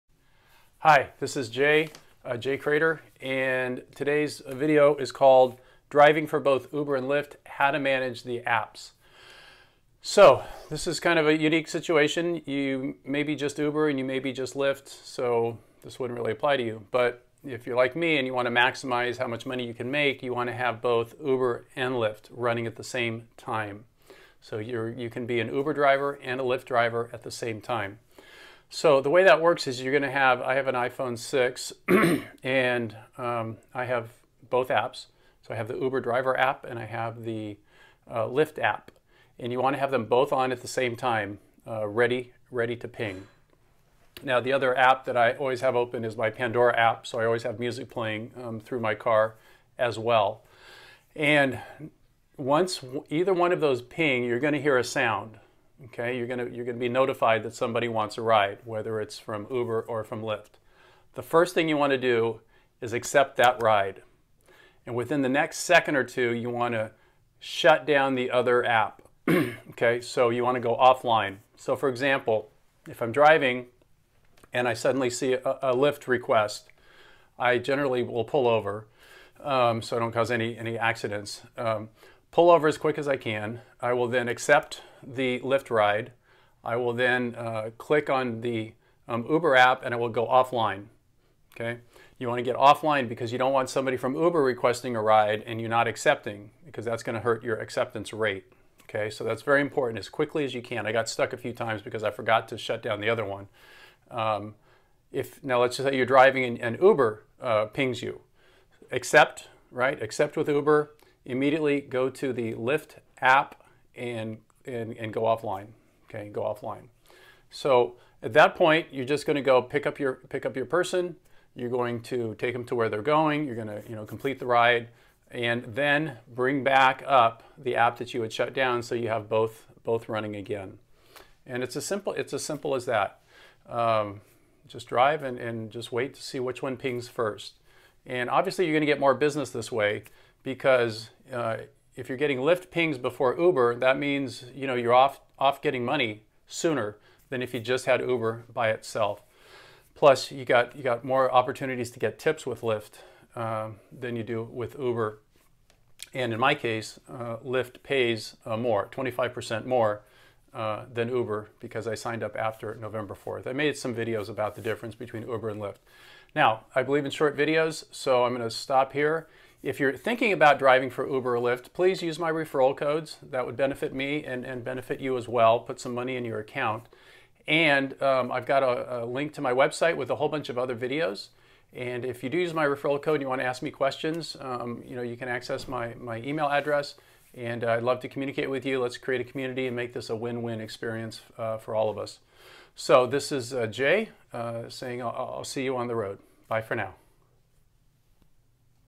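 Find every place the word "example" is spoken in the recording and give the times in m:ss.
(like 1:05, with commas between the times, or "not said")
1:11.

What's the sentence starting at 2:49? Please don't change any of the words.
If you're thinking about driving for Uber or Lyft, please use my referral codes.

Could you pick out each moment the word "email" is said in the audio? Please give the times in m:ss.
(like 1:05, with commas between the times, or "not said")
3:06.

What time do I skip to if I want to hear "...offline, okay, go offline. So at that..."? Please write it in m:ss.
1:55.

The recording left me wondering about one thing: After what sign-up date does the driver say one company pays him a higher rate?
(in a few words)
November 4th.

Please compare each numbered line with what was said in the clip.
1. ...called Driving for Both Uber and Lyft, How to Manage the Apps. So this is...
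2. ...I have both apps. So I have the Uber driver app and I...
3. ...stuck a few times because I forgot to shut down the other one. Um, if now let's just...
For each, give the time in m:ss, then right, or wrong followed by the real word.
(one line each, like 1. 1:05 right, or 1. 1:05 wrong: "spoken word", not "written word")
1. 0:05 right
2. 0:33 right
3. 1:41 right.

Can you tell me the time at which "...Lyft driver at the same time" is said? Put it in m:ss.
0:26.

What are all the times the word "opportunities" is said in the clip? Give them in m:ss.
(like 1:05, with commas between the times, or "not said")
2:31.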